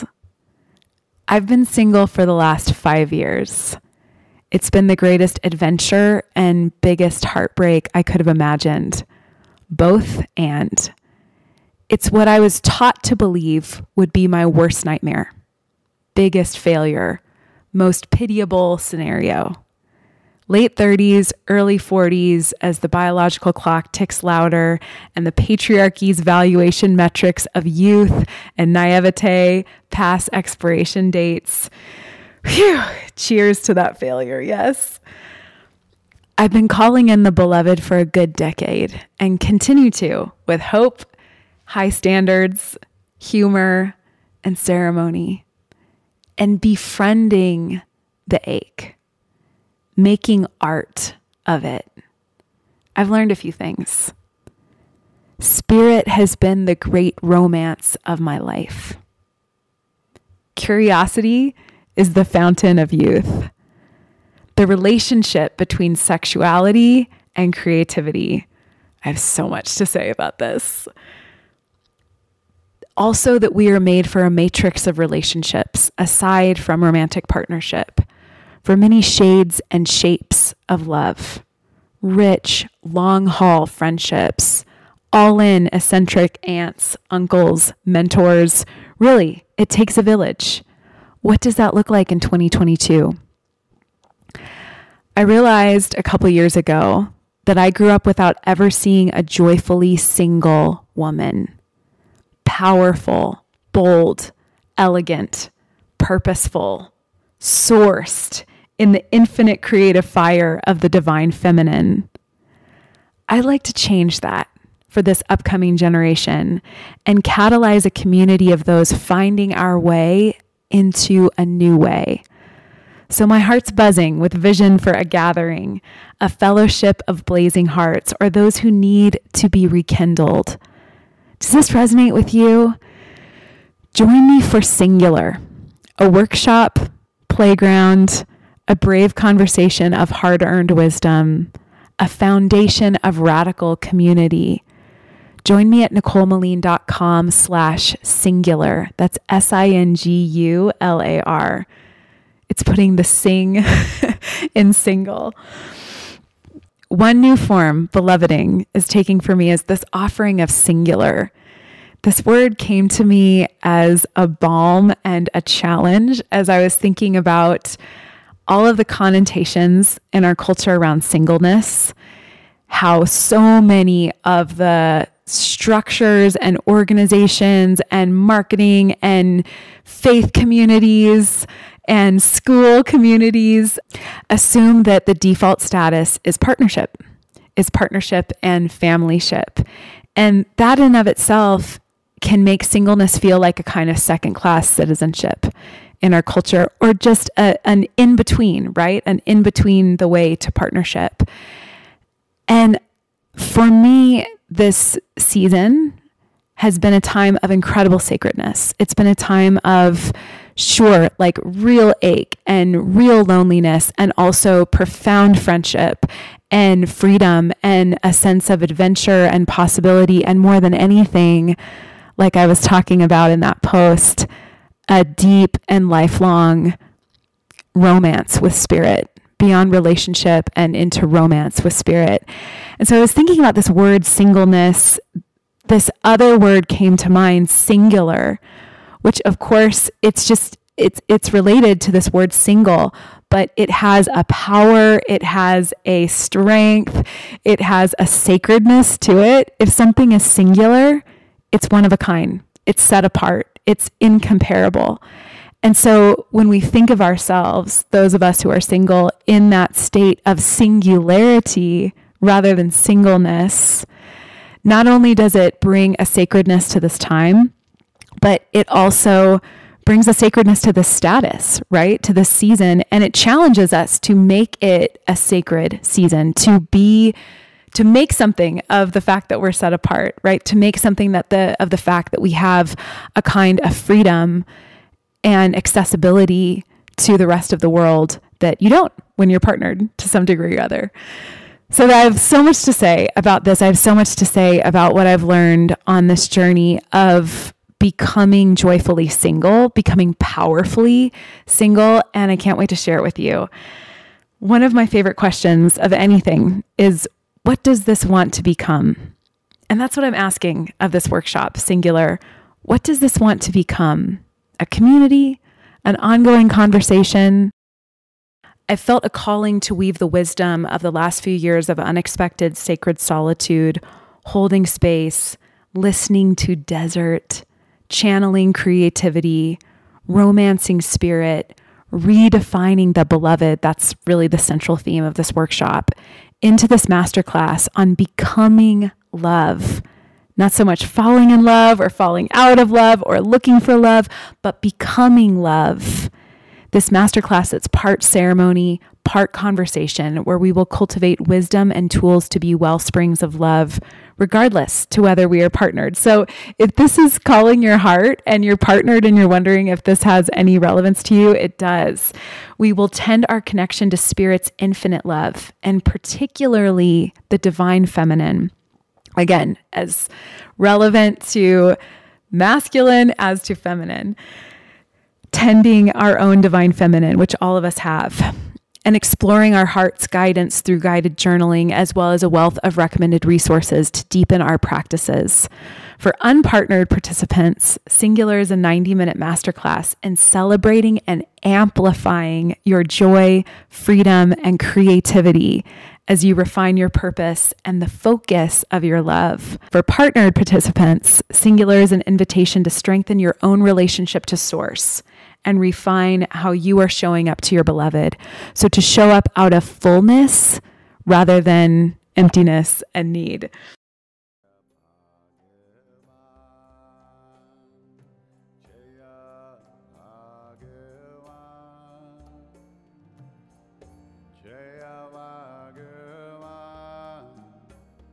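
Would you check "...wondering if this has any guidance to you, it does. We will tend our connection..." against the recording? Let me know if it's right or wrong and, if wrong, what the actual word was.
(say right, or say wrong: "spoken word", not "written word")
wrong: "relevance", not "guidance".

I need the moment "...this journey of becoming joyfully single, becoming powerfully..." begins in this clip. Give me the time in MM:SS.
04:56.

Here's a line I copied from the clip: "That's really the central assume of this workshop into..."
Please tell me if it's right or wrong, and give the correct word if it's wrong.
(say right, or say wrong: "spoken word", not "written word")
wrong: "theme", not "assume".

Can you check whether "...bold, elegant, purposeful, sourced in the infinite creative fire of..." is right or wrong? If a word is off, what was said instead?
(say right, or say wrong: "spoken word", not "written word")
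right.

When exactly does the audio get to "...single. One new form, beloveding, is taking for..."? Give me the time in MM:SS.
02:34.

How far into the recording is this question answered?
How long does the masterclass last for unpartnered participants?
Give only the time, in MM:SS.
06:28.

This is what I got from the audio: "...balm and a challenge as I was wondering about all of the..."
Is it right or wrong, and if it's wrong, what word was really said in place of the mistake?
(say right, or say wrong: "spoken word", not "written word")
wrong: "thinking", not "wondering".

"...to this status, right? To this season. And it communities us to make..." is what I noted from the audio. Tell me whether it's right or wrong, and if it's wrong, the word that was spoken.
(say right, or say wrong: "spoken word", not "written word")
wrong: "challenges", not "communities".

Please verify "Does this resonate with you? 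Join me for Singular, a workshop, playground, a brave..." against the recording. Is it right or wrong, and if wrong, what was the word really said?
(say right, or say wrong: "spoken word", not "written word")
right.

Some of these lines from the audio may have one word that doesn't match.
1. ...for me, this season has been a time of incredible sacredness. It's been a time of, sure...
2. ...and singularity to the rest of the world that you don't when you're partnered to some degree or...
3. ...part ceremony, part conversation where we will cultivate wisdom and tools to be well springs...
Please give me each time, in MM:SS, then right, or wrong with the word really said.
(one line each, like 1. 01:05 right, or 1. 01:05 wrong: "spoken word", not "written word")
1. 03:23 right
2. 04:45 wrong: "accessibility", not "singularity"
3. 05:47 right.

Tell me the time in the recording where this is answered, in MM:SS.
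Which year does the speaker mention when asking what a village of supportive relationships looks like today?
01:32.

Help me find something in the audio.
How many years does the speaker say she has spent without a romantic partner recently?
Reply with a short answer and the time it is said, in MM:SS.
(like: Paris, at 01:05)
5, at 00:02.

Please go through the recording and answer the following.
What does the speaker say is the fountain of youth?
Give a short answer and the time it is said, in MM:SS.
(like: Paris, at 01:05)
Curiosity, at 01:00.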